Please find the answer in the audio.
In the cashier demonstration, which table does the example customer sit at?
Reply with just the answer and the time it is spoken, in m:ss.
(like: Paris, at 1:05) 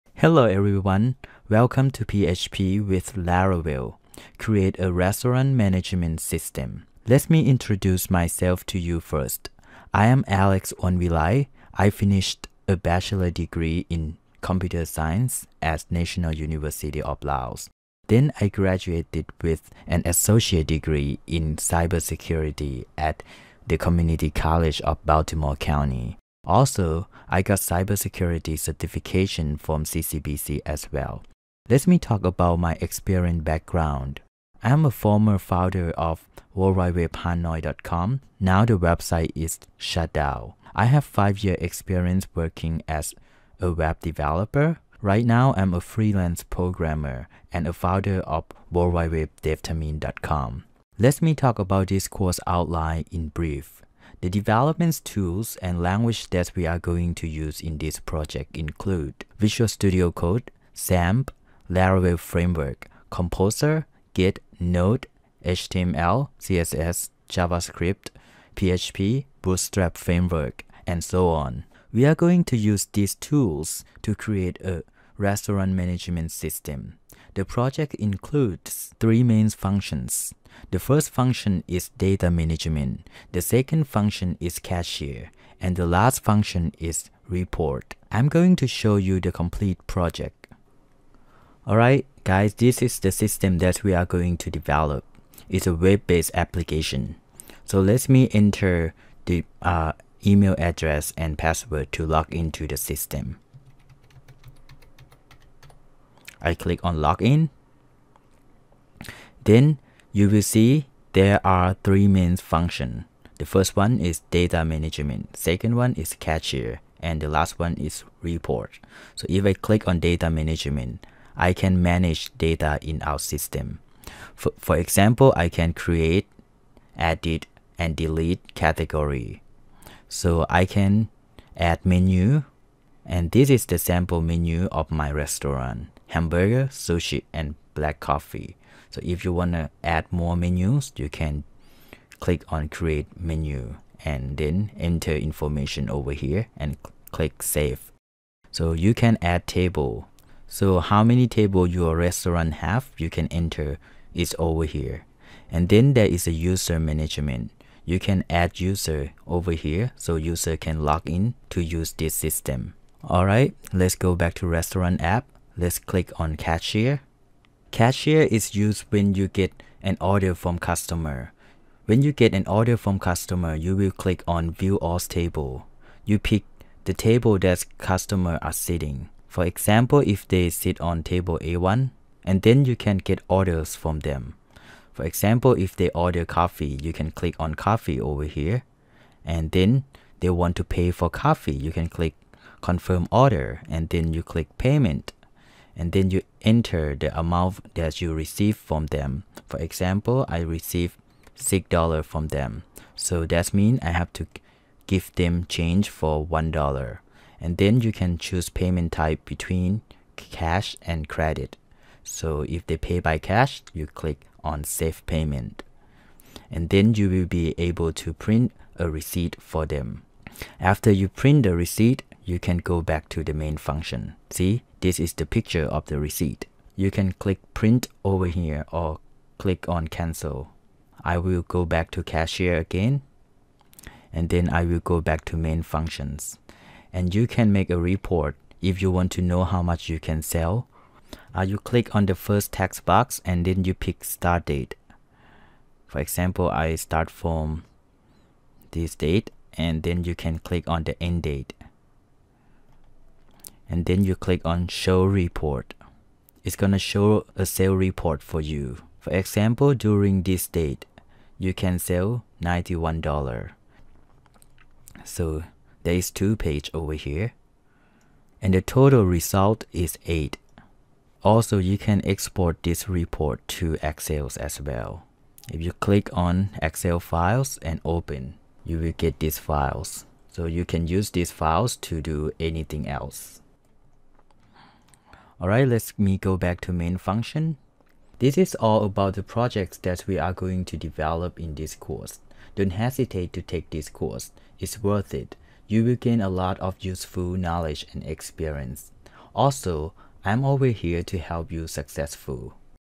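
A1, at 3:01.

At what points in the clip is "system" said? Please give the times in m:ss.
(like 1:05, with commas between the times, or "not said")
0:06, 1:16, 1:33, 1:42, 2:03, 2:42.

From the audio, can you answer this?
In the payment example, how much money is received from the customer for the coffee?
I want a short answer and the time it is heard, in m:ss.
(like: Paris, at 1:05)
$6, at 3:21.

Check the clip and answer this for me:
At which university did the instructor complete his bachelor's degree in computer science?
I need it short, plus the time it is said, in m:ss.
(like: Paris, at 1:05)
National University of Laos, at 0:15.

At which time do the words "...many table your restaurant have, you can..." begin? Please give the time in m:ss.
2:31.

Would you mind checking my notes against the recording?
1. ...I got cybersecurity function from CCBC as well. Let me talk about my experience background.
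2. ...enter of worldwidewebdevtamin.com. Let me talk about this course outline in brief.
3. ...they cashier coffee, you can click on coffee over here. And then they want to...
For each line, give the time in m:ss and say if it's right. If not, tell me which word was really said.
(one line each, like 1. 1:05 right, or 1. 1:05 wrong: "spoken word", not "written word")
1. 0:27 wrong: "certification", not "function"
2. 0:47 wrong: "founder", not "enter"
3. 3:05 wrong: "order", not "cashier".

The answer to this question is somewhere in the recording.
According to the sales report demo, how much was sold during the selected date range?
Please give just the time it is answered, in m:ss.
4:22.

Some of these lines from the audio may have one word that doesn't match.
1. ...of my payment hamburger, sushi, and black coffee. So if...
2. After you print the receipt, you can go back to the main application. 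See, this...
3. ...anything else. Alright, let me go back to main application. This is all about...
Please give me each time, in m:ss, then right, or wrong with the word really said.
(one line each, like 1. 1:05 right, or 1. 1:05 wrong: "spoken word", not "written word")
1. 2:14 wrong: "restaurant", not "payment"
2. 3:40 wrong: "function", not "application"
3. 4:42 wrong: "function", not "application".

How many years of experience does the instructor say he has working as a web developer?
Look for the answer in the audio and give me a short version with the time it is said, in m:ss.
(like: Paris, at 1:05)
5, at 0:41.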